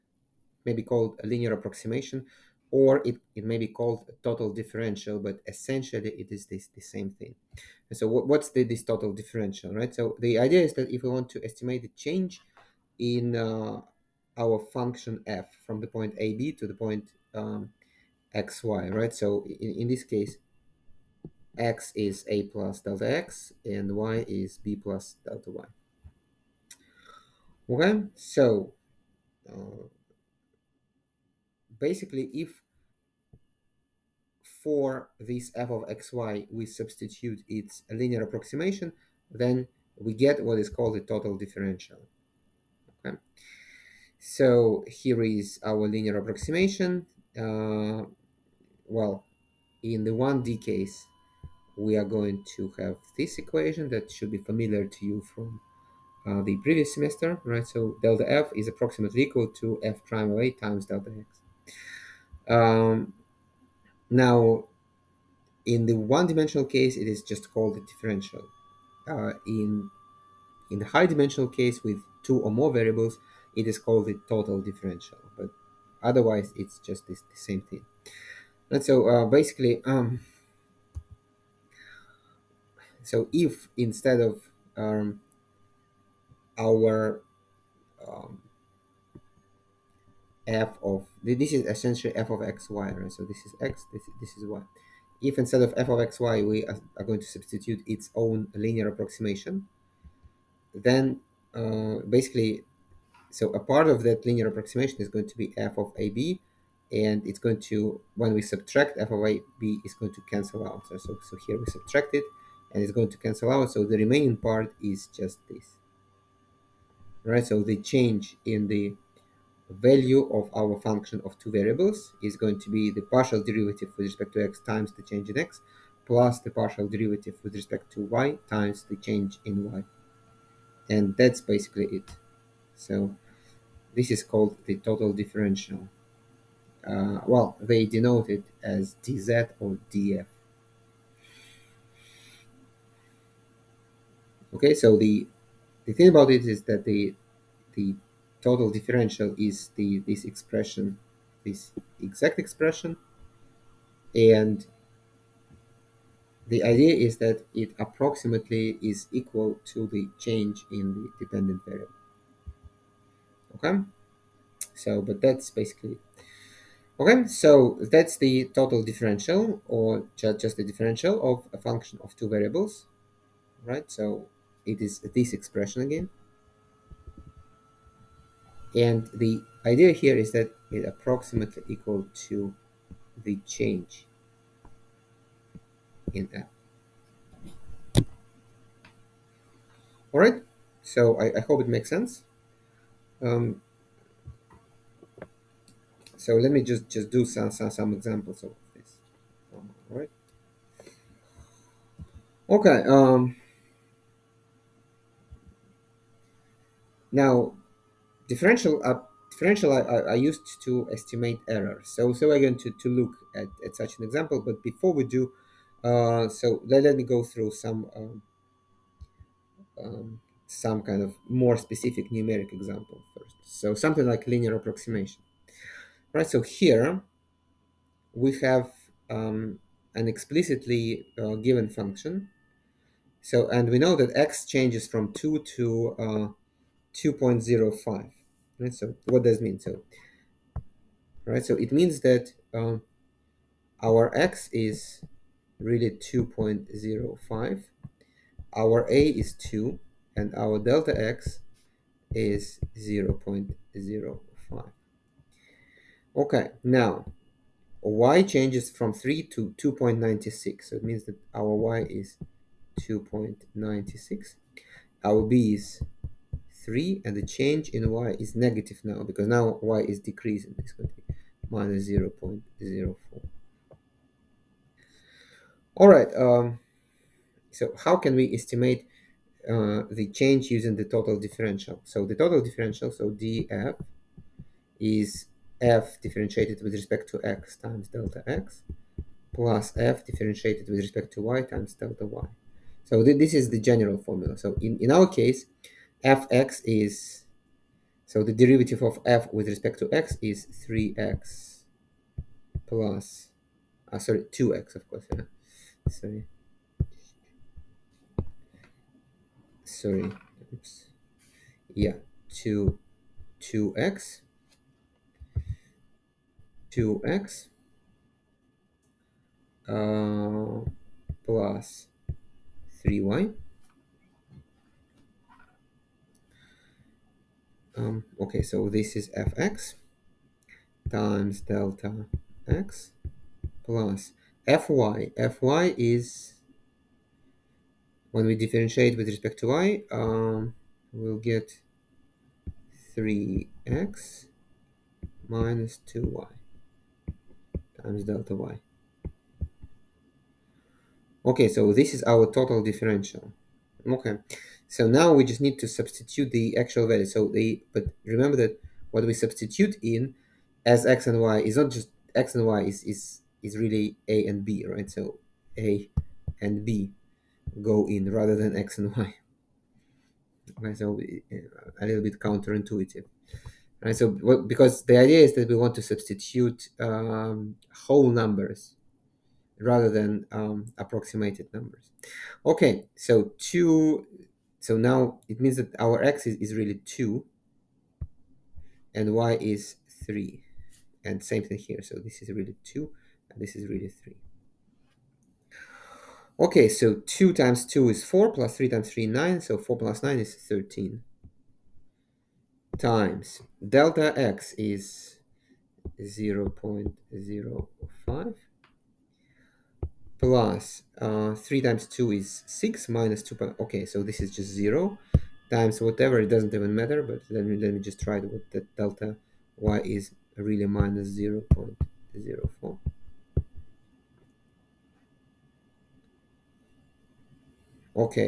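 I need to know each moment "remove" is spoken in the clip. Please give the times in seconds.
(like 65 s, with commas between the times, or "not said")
not said.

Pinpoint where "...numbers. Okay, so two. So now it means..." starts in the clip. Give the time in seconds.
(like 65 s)
381 s.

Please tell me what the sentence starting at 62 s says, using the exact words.
Um, now, in the one-dimensional case, it is just called a differential.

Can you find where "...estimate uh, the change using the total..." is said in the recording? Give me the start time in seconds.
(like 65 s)
278 s.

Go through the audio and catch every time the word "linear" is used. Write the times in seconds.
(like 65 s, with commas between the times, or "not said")
1 s, 37 s, 45 s, 98 s, 104 s, 224 s.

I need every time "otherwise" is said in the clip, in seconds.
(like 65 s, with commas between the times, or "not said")
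76 s.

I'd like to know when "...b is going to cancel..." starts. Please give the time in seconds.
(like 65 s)
109 s.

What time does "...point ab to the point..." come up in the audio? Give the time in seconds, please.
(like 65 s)
15 s.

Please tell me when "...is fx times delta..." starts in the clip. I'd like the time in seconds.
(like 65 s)
328 s.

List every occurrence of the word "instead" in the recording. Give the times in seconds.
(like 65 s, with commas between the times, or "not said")
83 s, 95 s.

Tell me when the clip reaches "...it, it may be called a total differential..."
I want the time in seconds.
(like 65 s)
3 s.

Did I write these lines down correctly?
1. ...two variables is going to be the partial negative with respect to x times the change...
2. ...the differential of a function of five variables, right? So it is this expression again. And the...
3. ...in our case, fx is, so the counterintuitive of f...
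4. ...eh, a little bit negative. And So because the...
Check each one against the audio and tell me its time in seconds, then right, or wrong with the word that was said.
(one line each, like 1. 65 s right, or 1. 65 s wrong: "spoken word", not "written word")
1. 121 s wrong: "derivative", not "negative"
2. 170 s wrong: "two", not "five"
3. 294 s wrong: "derivative", not "counterintuitive"
4. 371 s wrong: "counterintuitive", not "negative".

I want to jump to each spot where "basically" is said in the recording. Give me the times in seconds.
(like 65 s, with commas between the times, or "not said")
31 s, 79 s, 102 s, 131 s, 165 s.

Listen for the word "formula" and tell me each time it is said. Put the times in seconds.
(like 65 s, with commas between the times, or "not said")
293 s.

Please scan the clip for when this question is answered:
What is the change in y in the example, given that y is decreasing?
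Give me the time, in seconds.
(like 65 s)
271 s.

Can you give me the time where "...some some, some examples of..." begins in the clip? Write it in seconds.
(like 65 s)
197 s.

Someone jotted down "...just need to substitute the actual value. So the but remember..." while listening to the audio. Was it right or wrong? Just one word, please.
right.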